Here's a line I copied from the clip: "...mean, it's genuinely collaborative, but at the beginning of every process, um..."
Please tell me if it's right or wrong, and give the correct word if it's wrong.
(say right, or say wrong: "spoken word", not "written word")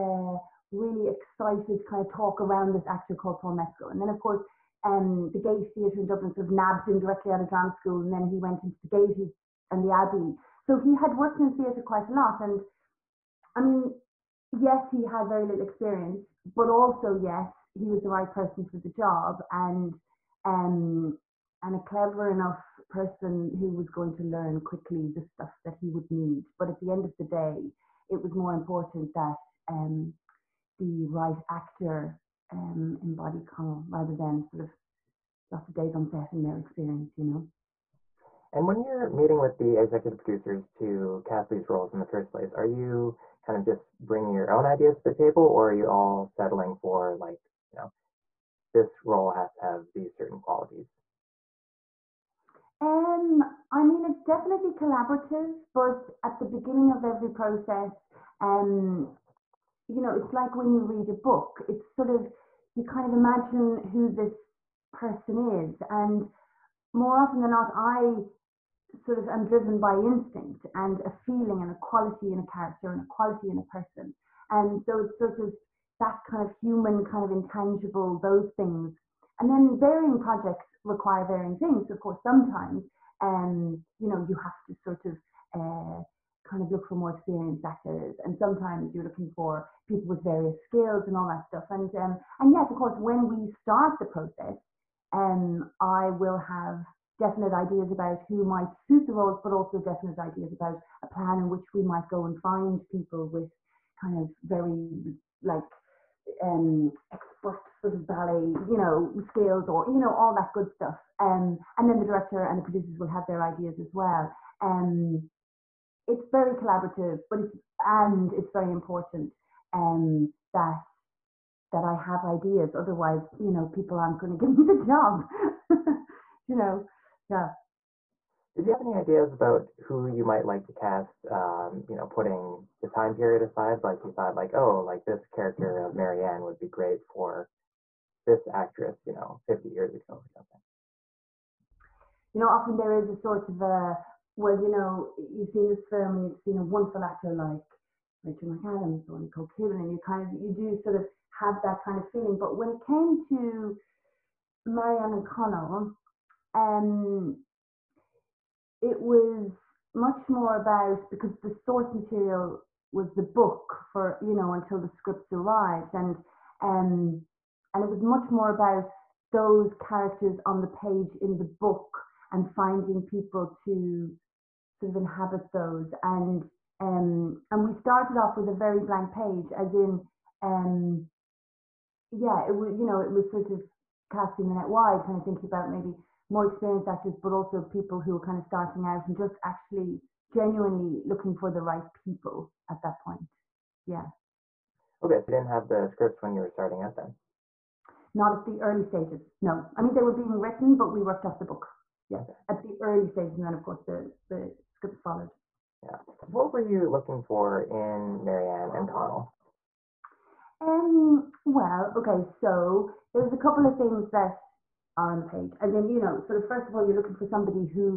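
wrong: "definitely", not "genuinely".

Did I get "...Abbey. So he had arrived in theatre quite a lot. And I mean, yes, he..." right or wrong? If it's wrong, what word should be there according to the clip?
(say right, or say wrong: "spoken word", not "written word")
wrong: "worked", not "arrived".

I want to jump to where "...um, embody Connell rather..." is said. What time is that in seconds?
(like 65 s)
32 s.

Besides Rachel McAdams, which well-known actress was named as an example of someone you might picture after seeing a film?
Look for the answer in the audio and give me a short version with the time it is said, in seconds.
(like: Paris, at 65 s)
Nicole Kidman, at 149 s.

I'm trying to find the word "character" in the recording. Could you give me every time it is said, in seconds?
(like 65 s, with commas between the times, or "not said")
72 s, 135 s, 169 s.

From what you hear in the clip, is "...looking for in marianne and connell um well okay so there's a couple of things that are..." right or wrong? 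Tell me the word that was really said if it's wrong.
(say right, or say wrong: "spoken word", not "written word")
right.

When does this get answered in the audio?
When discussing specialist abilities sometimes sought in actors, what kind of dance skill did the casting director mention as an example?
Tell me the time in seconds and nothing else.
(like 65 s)
108 s.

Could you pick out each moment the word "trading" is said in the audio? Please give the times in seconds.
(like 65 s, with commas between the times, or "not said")
not said.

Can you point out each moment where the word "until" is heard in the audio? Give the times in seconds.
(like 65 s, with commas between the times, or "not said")
164 s.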